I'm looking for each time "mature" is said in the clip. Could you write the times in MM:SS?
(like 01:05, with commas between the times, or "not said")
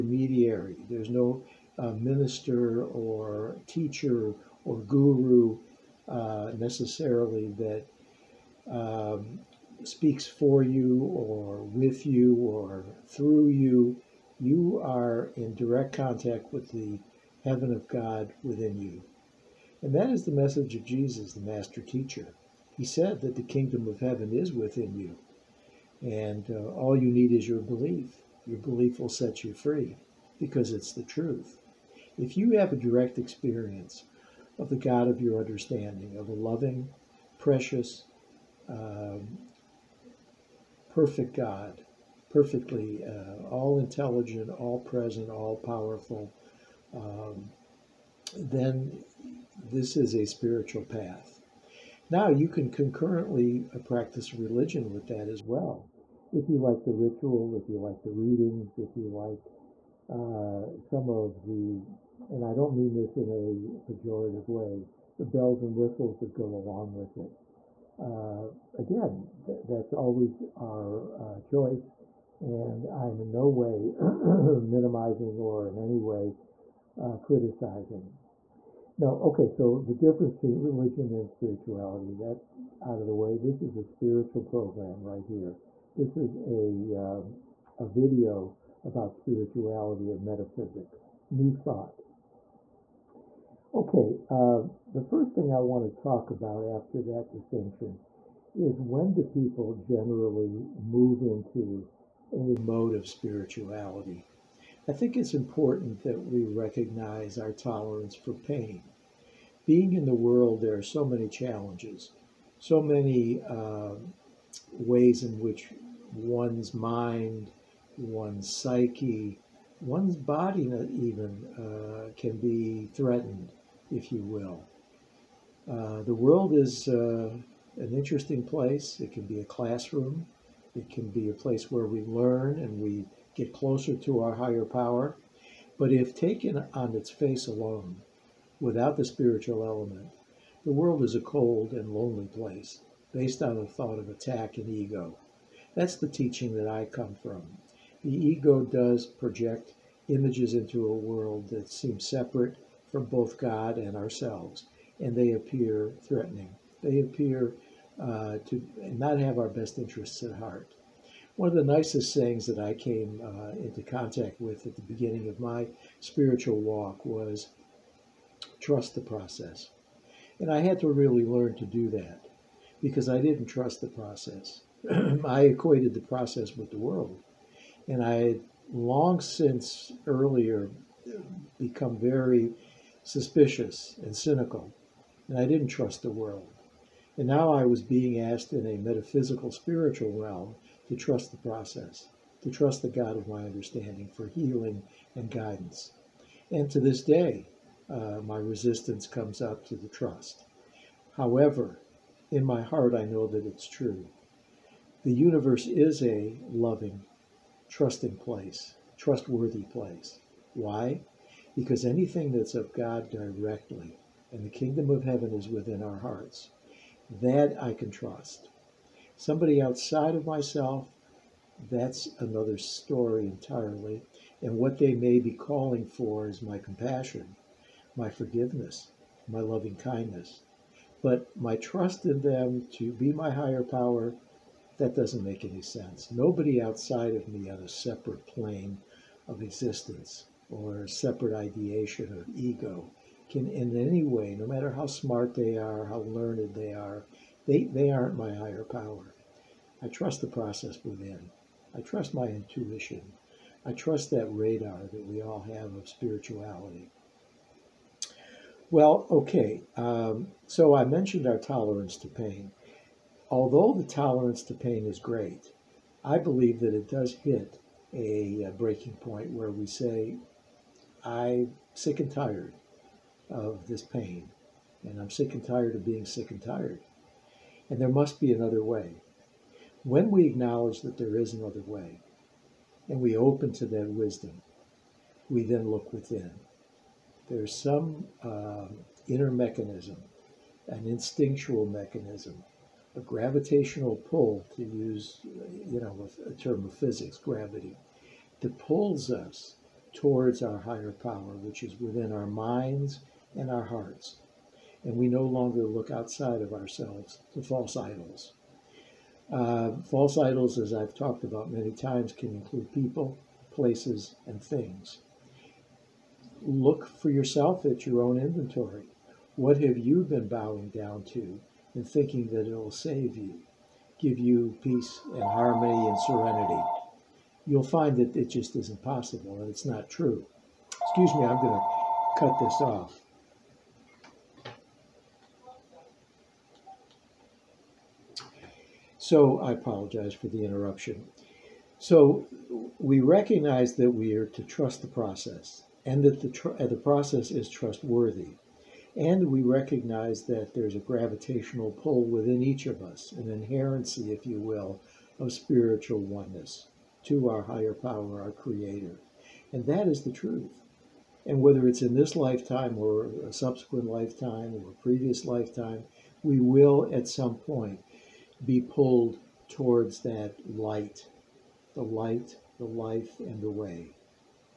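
not said.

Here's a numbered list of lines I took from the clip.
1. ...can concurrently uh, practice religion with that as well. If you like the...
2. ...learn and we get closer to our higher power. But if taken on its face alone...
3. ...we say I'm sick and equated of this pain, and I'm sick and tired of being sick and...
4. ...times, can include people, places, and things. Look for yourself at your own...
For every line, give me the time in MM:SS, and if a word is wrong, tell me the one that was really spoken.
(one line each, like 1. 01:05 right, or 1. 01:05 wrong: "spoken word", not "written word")
1. 00:52 right
2. 02:12 right
3. 04:29 wrong: "tired", not "equated"
4. 05:11 right.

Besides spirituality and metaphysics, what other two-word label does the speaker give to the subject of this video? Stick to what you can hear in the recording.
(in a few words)
New thought.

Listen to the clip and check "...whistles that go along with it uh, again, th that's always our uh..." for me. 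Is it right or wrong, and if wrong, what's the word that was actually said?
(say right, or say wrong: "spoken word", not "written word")
right.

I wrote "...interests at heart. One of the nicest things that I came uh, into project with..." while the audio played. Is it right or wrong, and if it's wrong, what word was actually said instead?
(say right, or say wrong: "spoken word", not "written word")
wrong: "contact", not "project".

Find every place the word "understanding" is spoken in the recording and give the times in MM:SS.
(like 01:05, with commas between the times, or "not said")
00:35, 03:13.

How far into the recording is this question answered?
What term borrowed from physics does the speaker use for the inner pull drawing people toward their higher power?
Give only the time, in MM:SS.
04:57.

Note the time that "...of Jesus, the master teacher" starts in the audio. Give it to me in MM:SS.
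00:20.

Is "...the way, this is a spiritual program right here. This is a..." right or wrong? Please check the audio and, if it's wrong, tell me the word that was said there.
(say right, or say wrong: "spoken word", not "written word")
right.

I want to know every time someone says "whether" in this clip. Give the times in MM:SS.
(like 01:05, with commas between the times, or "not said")
06:01.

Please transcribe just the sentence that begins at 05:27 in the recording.
you'll find that it just isn't possible and it's not true.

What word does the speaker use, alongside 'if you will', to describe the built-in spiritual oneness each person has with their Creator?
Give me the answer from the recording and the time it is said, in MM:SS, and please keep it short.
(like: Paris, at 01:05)
Inherency, at 05:53.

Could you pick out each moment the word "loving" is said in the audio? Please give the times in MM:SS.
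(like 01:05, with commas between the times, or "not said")
00:36, 03:26, 03:49.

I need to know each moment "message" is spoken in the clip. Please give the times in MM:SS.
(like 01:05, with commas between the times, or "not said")
00:20.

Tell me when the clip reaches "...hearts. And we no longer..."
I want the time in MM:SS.
05:03.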